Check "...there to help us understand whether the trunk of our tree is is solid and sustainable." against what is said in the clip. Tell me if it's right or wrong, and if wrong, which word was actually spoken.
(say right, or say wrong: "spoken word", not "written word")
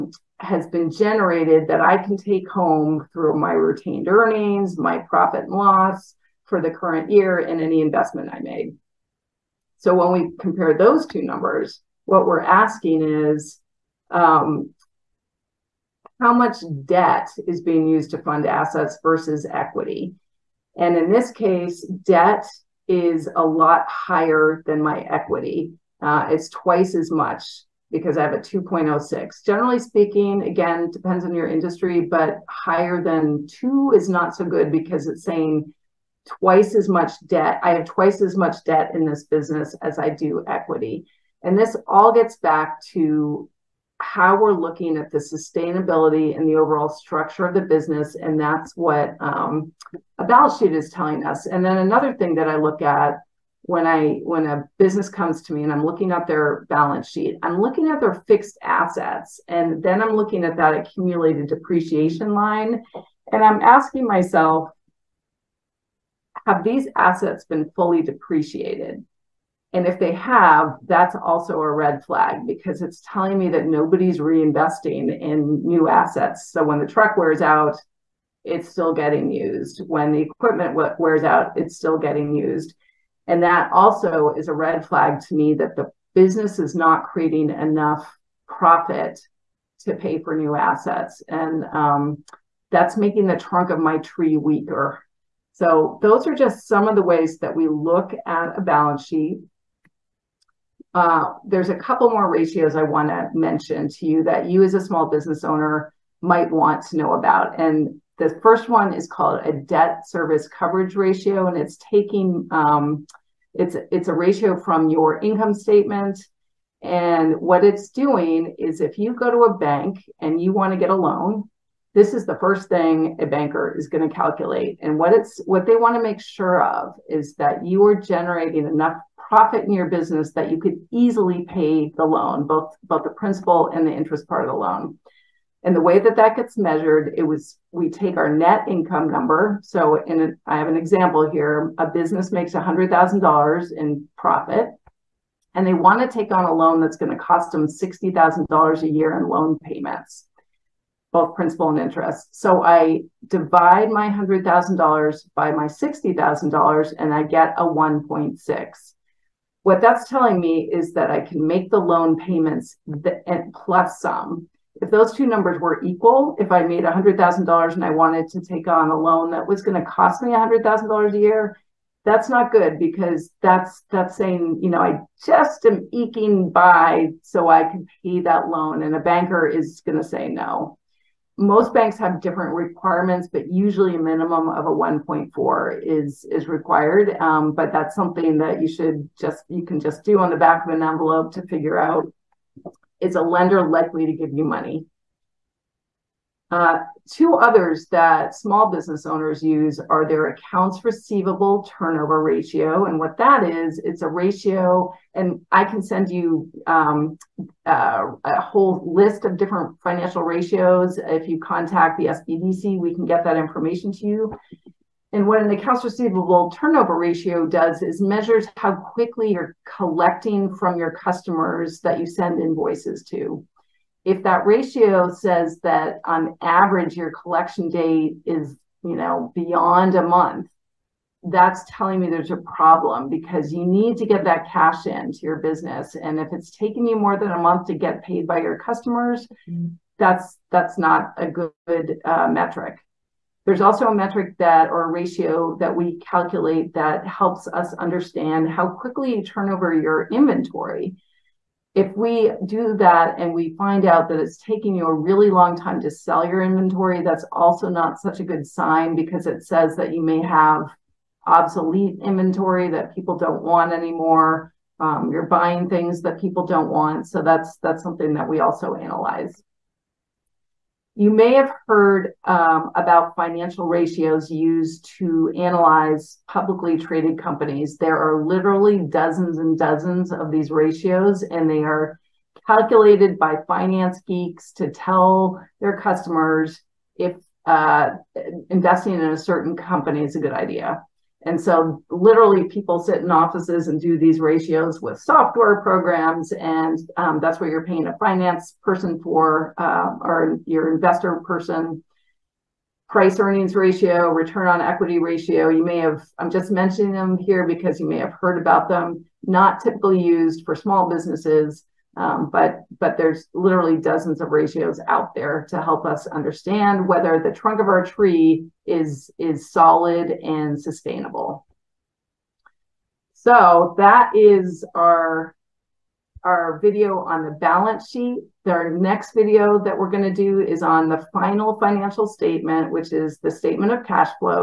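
right.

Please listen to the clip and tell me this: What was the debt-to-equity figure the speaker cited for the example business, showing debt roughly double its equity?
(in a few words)
2.06.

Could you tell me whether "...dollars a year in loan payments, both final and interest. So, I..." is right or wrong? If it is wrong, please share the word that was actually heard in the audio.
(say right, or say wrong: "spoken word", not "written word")
wrong: "principal", not "final".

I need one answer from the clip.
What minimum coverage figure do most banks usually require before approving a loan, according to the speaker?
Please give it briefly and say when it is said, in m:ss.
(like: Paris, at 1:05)
1.4, at 3:04.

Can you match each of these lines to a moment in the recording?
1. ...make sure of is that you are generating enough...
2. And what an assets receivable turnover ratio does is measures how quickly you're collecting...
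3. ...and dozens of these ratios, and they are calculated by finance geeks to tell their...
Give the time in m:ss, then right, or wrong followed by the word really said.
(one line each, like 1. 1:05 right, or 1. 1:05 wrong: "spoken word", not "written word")
1. 2:06 right
2. 3:35 wrong: "accounts", not "assets"
3. 4:39 right.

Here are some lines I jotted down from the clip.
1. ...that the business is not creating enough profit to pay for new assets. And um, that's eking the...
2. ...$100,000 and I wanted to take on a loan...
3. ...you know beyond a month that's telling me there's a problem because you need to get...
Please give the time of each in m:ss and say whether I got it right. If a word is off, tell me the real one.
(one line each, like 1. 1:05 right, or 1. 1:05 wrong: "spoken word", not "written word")
1. 1:25 wrong: "making", not "eking"
2. 2:46 right
3. 3:48 right.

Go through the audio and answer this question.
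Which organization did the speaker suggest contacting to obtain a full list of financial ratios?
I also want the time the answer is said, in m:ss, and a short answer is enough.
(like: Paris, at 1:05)
SBDC, at 3:32.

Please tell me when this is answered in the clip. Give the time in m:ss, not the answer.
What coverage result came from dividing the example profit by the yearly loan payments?
2:37.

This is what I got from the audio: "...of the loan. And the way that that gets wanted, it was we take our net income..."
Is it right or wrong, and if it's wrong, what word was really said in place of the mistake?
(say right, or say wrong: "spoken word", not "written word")
wrong: "measured", not "wanted".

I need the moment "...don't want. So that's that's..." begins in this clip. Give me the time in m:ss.
4:26.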